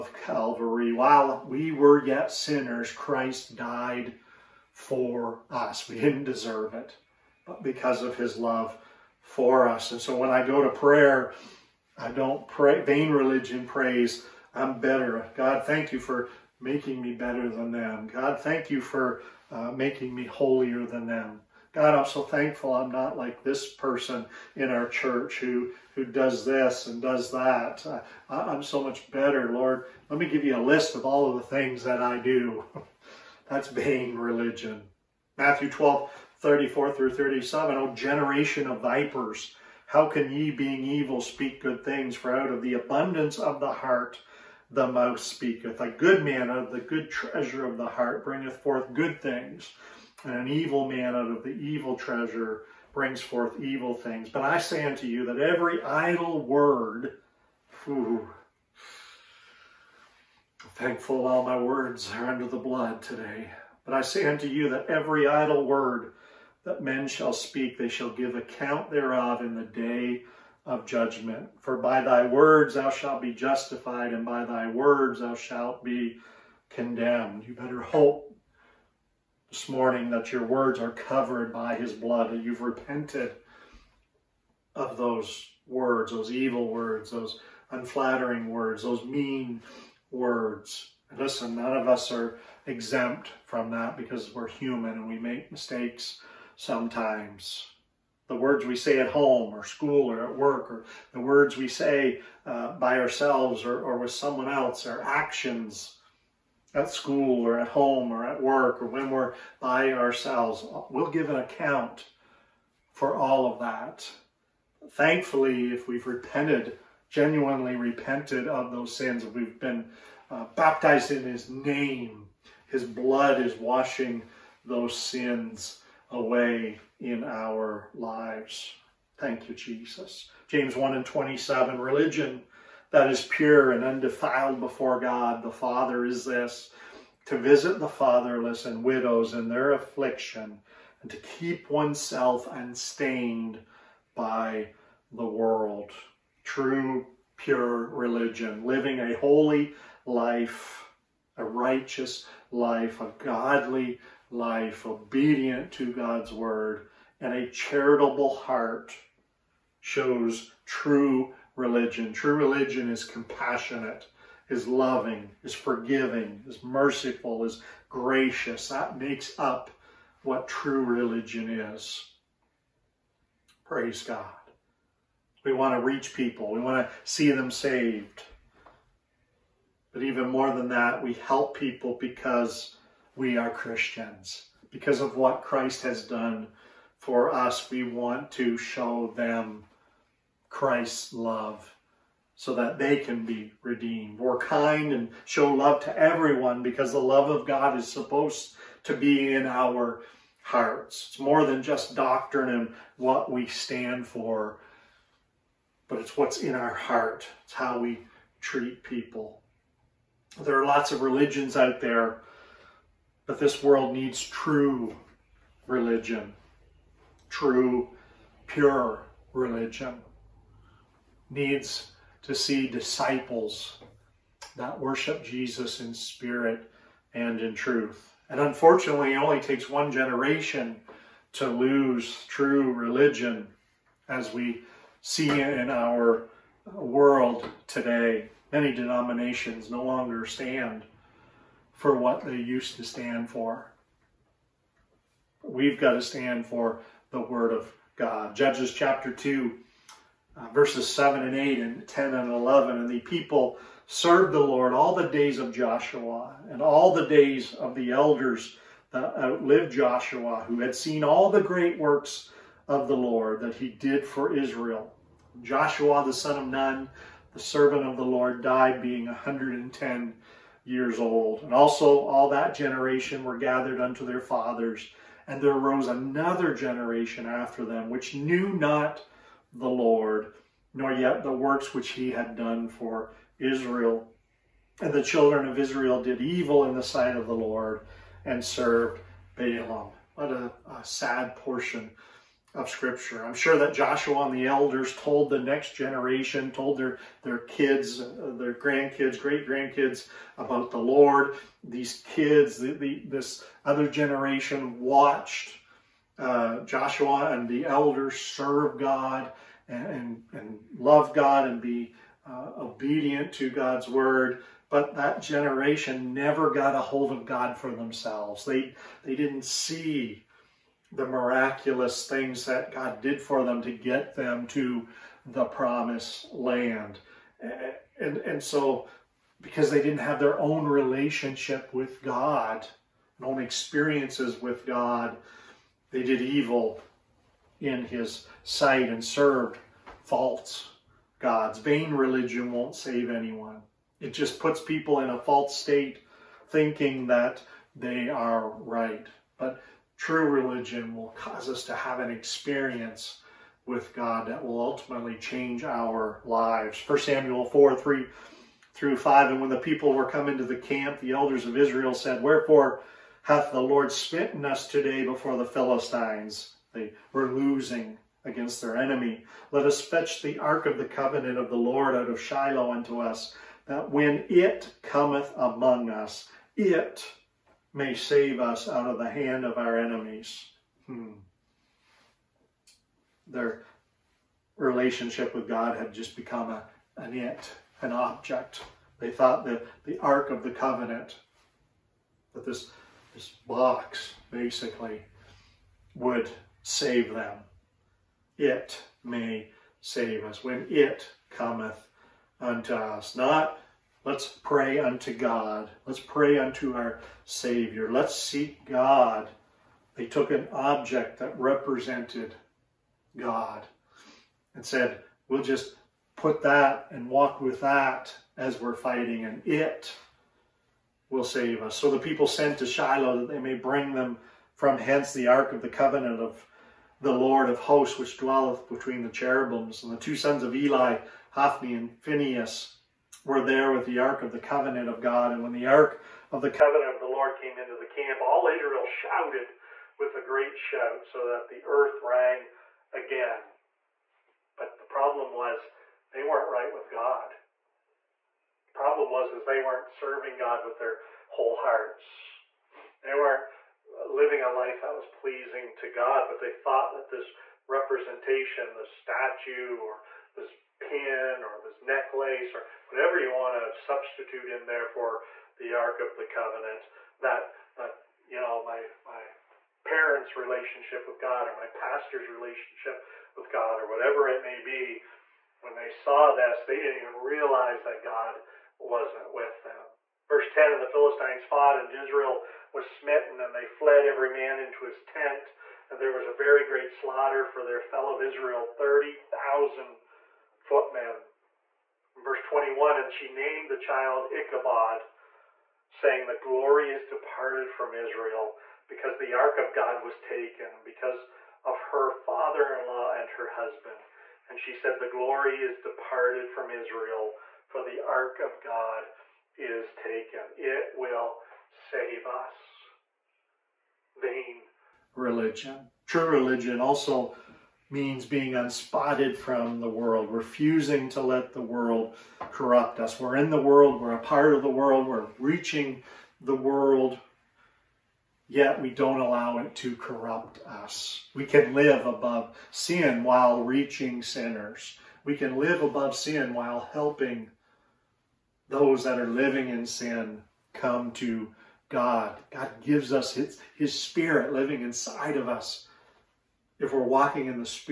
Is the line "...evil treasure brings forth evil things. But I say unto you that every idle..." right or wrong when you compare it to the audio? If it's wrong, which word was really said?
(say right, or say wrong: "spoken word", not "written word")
right.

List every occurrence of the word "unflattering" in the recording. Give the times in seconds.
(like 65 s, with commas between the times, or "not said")
87 s.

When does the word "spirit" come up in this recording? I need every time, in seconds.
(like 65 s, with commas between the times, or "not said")
225 s, 543 s.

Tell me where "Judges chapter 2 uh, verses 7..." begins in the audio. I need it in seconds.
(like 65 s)
248 s.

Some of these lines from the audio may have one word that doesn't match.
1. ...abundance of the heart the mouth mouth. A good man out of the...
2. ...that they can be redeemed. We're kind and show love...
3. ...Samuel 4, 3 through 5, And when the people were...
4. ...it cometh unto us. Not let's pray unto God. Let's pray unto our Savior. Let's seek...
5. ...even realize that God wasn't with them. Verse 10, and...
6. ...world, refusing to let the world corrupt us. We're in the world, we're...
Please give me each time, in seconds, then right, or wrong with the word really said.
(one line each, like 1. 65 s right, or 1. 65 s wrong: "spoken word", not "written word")
1. 42 s wrong: "speaketh", not "mouth"
2. 192 s right
3. 356 s right
4. 400 s right
5. 477 s right
6. 519 s right.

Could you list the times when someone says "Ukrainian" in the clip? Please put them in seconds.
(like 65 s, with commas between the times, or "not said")
not said.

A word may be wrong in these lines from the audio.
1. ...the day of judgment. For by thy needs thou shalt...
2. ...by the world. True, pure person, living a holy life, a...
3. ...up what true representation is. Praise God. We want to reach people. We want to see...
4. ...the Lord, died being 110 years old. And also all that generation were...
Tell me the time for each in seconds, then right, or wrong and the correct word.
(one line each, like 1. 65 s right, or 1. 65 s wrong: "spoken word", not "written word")
1. 69 s wrong: "words", not "needs"
2. 144 s wrong: "religion", not "person"
3. 169 s wrong: "religion", not "representation"
4. 267 s right.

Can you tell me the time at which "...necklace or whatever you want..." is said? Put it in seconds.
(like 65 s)
461 s.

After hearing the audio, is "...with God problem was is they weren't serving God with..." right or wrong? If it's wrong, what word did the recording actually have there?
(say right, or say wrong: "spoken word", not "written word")
right.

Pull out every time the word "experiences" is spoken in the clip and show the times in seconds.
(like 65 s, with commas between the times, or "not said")
333 s, 352 s.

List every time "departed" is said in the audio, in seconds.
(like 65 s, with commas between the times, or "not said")
497 s, 505 s.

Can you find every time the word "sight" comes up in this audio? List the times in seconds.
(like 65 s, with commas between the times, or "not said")
286 s, 338 s.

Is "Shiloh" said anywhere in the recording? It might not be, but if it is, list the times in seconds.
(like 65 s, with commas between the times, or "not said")
372 s, 422 s.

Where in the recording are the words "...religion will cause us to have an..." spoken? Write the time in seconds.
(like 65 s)
350 s.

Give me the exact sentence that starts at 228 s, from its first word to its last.
And unfortunately, it only takes one generation to lose true religion as we see in our world today.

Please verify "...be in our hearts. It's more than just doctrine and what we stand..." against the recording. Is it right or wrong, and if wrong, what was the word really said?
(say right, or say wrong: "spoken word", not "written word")
right.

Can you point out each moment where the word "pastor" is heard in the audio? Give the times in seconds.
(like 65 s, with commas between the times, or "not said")
471 s.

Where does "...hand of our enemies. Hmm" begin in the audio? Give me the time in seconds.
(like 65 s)
379 s.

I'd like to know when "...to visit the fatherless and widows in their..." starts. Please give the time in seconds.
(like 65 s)
137 s.